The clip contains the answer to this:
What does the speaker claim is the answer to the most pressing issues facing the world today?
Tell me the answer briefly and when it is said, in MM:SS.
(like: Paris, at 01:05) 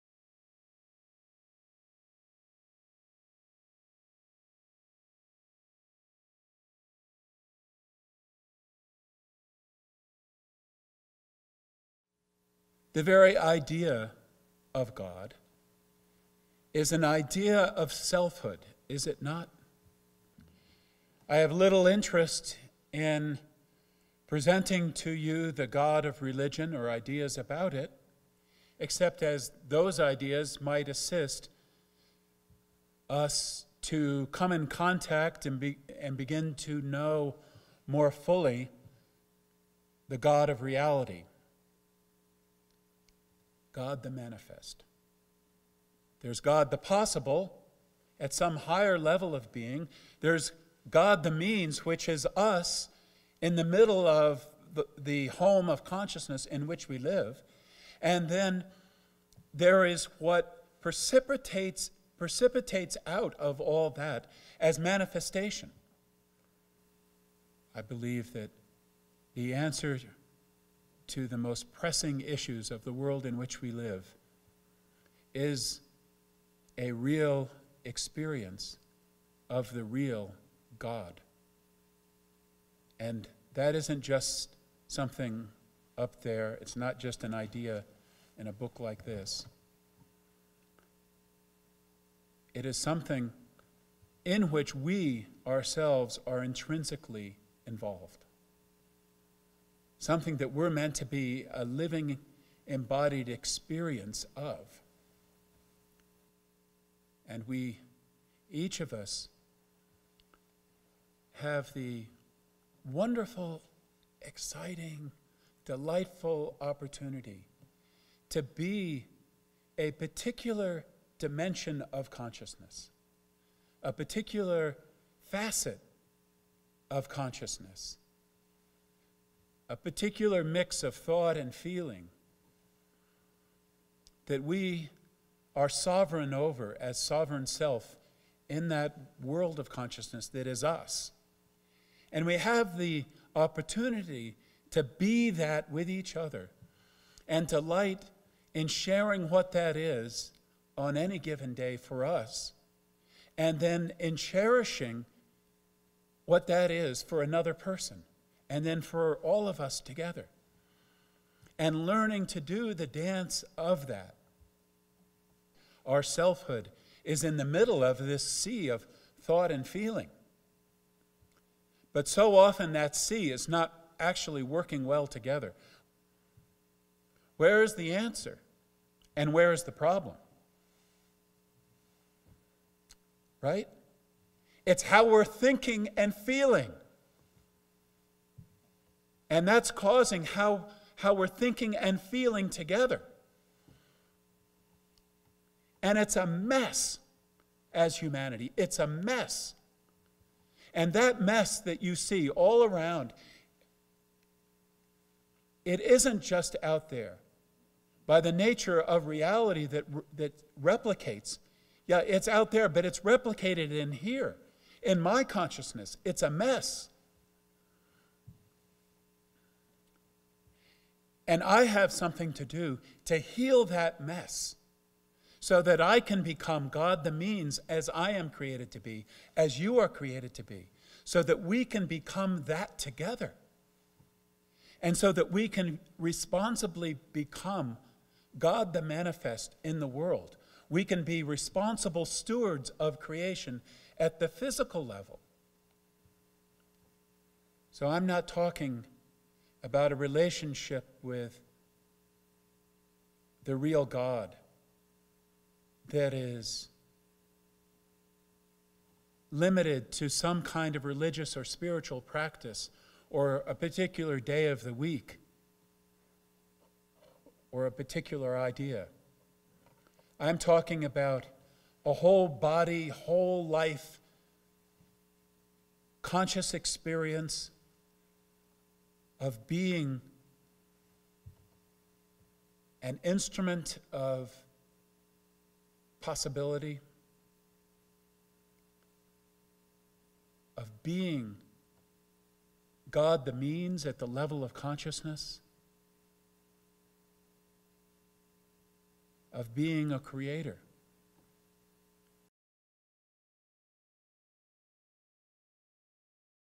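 a real experience of the real God, at 01:16.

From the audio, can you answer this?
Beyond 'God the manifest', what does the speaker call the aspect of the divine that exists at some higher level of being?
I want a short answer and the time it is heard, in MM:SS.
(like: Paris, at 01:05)
God the possible, at 00:46.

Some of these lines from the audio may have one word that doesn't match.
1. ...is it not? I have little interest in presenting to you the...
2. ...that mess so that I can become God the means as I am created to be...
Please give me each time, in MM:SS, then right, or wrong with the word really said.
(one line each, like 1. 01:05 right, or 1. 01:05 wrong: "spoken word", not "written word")
1. 00:18 right
2. 03:43 right.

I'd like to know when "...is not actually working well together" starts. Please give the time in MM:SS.
02:53.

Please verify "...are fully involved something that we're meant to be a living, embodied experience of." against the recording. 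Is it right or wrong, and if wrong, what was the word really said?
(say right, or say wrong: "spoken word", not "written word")
wrong: "intrinsically", not "fully".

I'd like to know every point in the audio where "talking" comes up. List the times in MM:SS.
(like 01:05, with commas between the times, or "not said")
04:08, 04:30.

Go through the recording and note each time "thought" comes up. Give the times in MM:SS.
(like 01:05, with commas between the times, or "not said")
02:10, 02:49.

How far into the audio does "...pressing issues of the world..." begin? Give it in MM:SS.
01:11.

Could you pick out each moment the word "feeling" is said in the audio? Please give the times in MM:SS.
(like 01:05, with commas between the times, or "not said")
02:11, 02:49, 03:06, 03:12.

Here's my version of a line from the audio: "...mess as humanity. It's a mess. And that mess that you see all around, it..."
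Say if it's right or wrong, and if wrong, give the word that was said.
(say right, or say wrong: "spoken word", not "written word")
right.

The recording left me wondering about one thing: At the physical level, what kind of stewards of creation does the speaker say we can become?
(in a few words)
responsible stewards.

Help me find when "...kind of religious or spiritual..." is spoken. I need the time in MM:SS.
04:20.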